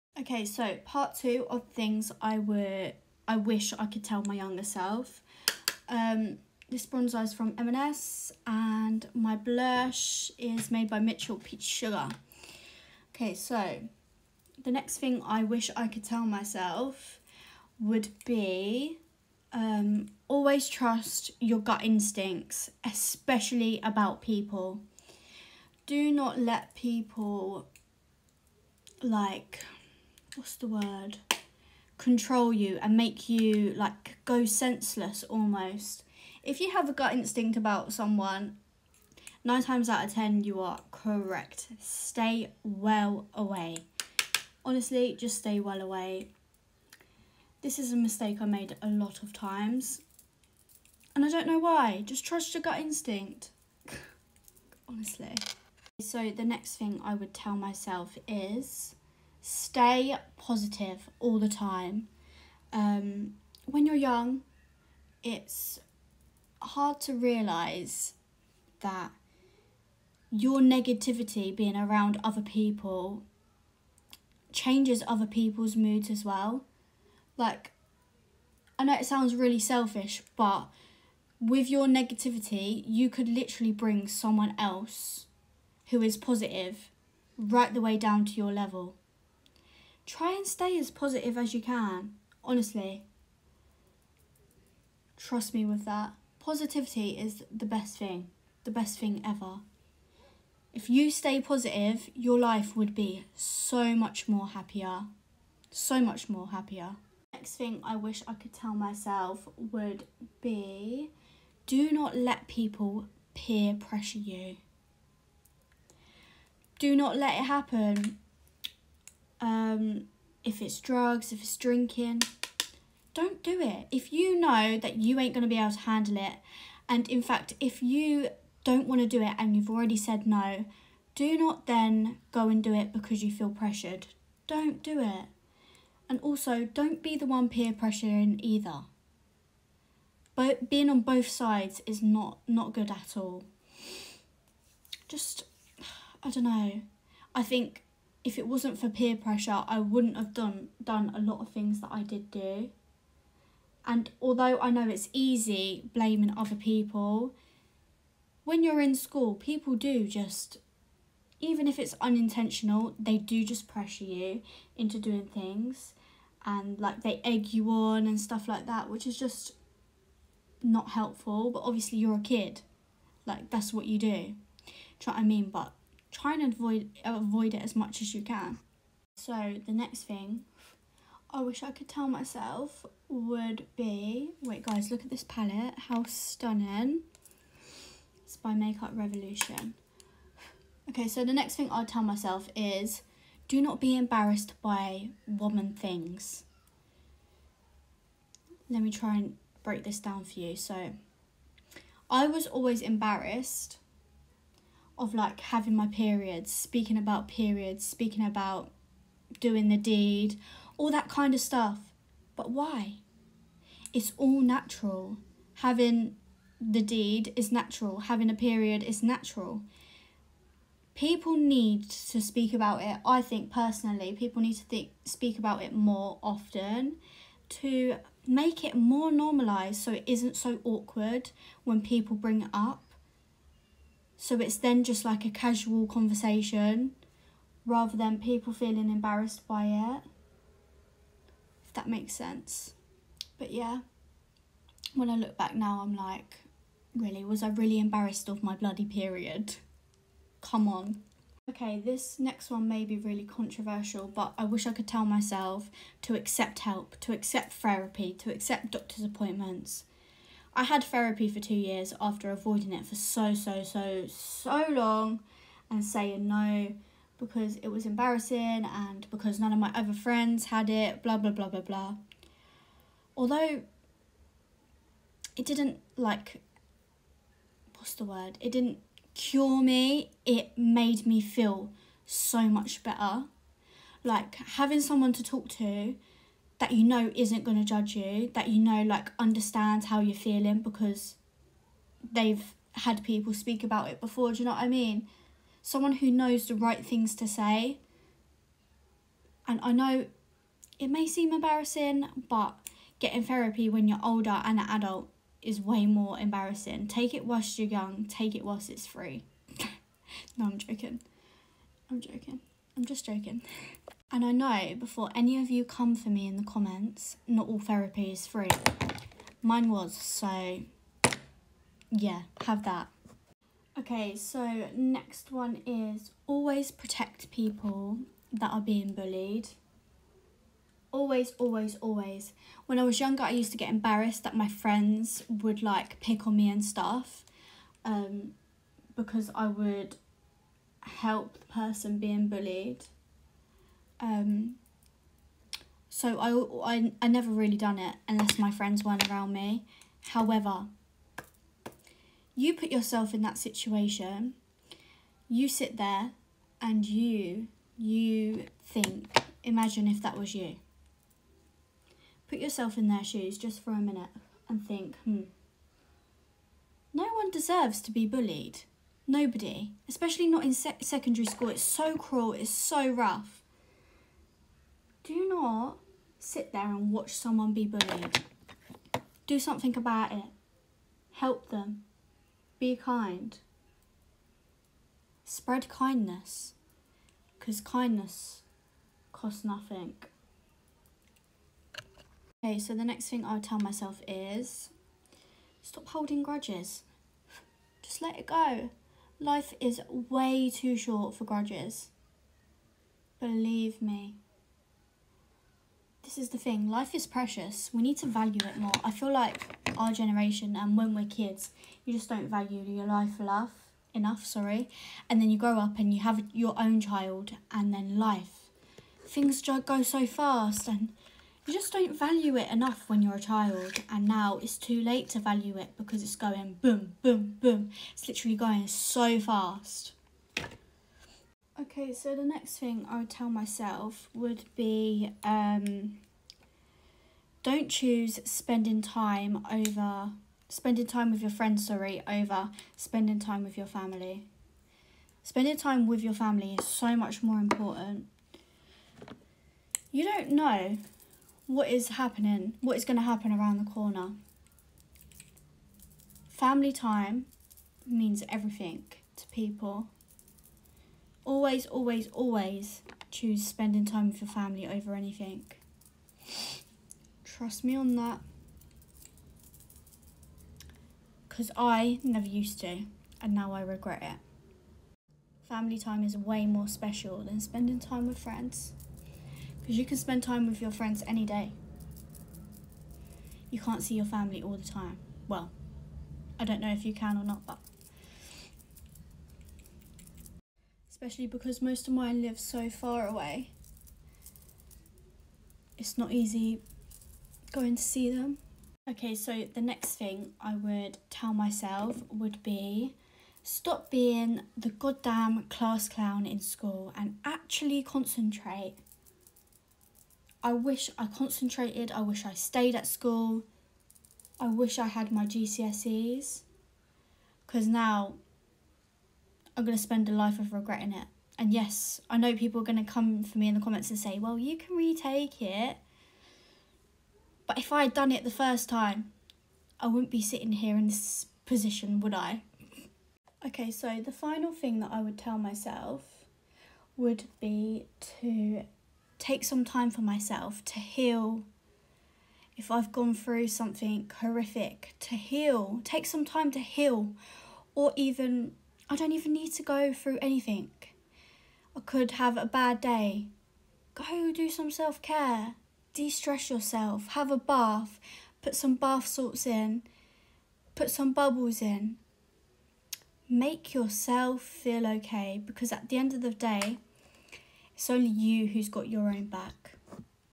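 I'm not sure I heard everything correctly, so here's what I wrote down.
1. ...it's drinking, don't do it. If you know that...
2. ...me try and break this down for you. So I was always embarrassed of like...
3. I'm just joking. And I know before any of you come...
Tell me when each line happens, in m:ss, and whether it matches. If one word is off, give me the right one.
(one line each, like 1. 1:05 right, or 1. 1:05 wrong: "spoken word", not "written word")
1. 2:01 right
2. 3:18 right
3. 5:12 right.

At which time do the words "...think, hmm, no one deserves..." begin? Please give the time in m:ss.
6:04.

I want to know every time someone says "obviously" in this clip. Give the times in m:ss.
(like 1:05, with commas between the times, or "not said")
2:51.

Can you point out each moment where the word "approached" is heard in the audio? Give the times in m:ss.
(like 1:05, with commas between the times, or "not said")
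not said.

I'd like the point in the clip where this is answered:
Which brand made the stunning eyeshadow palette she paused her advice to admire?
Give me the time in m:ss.
3:08.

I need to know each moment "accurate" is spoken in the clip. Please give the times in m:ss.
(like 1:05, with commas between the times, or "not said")
not said.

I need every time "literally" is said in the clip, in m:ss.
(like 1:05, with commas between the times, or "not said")
1:23, 7:08.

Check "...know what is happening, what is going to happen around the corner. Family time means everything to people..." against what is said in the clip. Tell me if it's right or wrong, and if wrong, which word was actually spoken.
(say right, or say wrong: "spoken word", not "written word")
right.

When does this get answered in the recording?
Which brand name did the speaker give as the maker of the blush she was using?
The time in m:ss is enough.
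0:10.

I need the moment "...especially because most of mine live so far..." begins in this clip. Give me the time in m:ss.
8:11.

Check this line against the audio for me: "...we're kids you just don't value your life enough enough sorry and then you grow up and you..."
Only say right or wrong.
right.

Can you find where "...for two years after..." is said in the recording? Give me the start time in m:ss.
4:21.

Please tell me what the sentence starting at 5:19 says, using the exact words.
Mine was, so yeah, have that.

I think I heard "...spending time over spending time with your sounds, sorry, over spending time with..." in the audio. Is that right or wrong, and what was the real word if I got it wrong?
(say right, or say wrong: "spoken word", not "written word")
wrong: "friends", not "sounds".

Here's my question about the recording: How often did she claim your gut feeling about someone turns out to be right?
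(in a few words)
9 times out of 10.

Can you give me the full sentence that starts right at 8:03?
You can't see your family all the time.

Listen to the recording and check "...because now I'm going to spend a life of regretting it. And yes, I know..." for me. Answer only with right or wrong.
right.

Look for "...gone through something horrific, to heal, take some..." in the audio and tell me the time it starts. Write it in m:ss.
9:02.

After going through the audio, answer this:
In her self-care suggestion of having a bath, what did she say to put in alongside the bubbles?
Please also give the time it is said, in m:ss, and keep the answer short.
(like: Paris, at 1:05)
Bath salts, at 9:18.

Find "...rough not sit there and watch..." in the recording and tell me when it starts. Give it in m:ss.
6:12.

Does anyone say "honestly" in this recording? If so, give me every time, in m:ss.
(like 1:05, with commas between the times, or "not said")
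0:44, 0:54, 1:32.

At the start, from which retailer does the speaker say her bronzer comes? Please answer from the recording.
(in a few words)
M&S.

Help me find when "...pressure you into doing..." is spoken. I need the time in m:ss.
2:43.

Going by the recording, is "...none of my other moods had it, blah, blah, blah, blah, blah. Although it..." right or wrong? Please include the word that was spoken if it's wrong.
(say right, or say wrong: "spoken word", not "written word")
wrong: "friends", not "moods".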